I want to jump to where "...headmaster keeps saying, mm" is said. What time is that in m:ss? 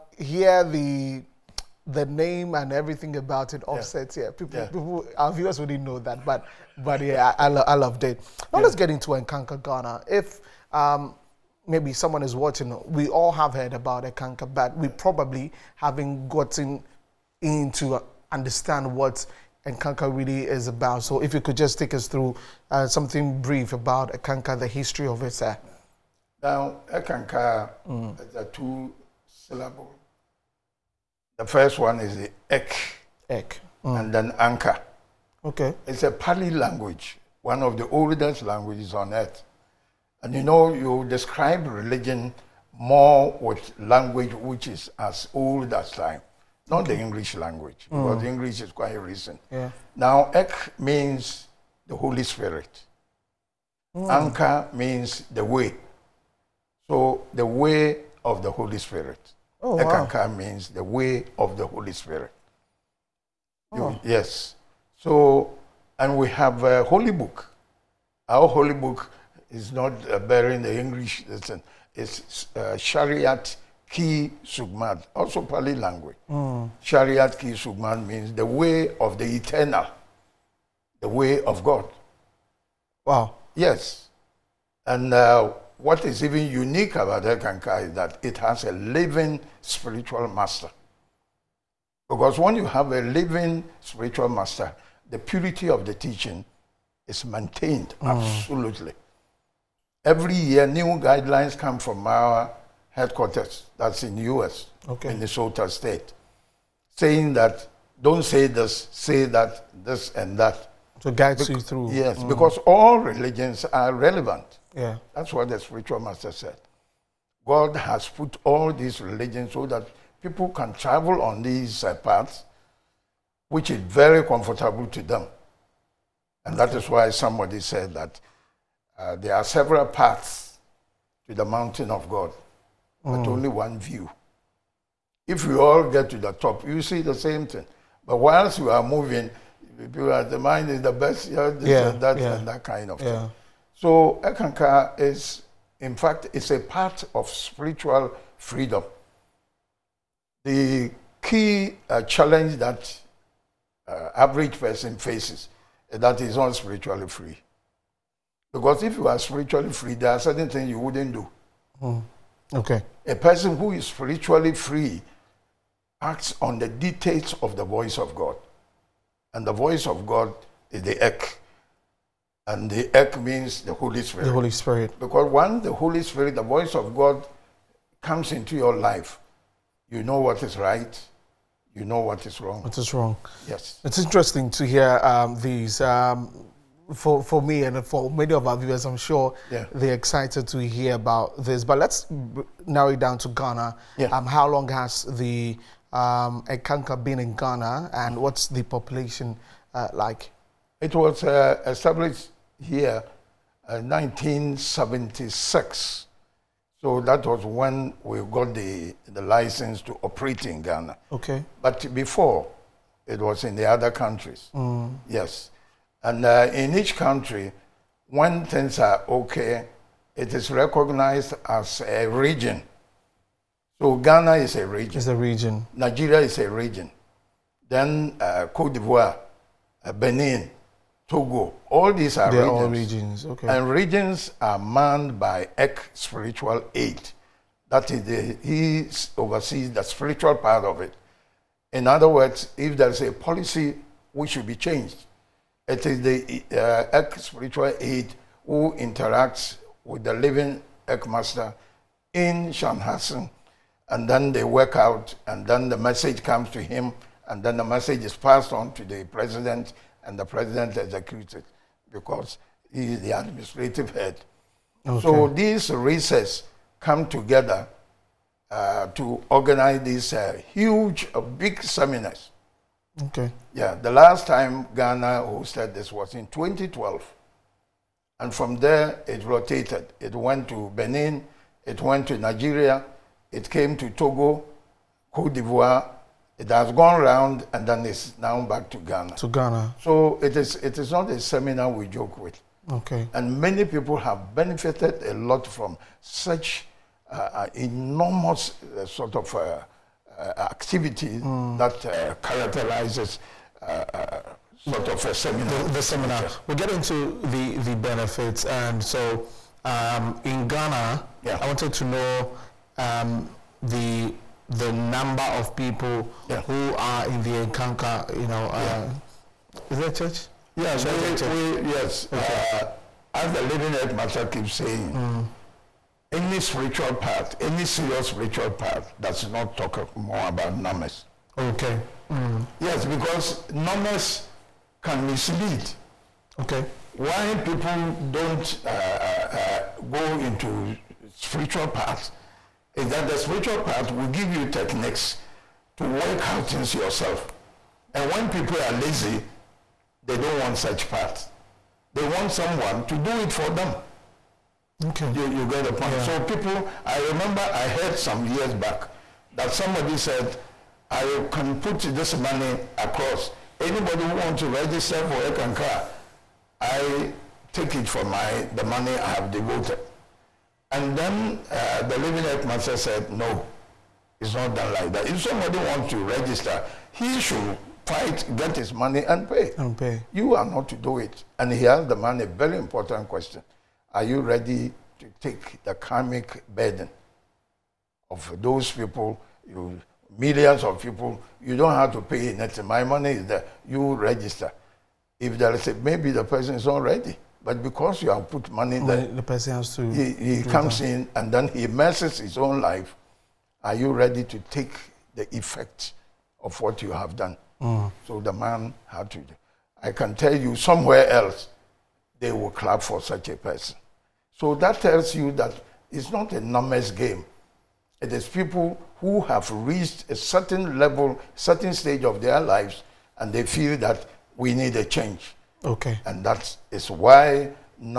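5:23.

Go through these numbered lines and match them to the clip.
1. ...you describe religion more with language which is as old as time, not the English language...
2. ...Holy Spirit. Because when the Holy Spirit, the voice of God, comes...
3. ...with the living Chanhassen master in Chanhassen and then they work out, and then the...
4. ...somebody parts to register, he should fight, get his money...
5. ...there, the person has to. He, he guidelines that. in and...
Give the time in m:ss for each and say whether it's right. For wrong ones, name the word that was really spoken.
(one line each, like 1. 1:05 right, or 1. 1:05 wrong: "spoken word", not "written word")
1. 0:40 right
2. 2:54 right
3. 4:09 wrong: "ECK", not "Chanhassen"
4. 6:15 wrong: "wants", not "parts"
5. 6:38 wrong: "comes", not "guidelines".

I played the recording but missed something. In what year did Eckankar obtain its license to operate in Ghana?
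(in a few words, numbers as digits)
1976.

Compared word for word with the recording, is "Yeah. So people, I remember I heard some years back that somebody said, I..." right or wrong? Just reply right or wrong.
right.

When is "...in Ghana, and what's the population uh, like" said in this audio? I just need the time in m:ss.
3:17.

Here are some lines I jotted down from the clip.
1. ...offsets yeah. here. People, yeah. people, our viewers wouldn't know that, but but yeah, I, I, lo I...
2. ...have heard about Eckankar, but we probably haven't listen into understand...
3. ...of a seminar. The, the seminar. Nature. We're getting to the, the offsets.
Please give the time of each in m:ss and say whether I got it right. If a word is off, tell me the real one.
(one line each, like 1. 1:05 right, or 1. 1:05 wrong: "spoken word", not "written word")
1. 0:03 right
2. 0:13 wrong: "gotten", not "listen"
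3. 5:04 wrong: "benefits", not "offsets".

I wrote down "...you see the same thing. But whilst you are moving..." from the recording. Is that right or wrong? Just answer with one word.
right.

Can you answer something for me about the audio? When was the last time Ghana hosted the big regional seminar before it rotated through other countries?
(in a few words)
2012.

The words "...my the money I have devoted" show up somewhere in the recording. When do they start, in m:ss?
6:08.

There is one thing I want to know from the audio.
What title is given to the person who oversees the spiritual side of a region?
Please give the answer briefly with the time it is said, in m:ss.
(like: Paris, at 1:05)
ECK spiritual aid, at 3:55.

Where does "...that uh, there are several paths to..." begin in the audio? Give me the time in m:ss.
2:07.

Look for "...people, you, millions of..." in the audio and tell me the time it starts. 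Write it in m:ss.
6:28.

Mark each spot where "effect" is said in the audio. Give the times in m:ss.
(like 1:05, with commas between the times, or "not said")
6:45.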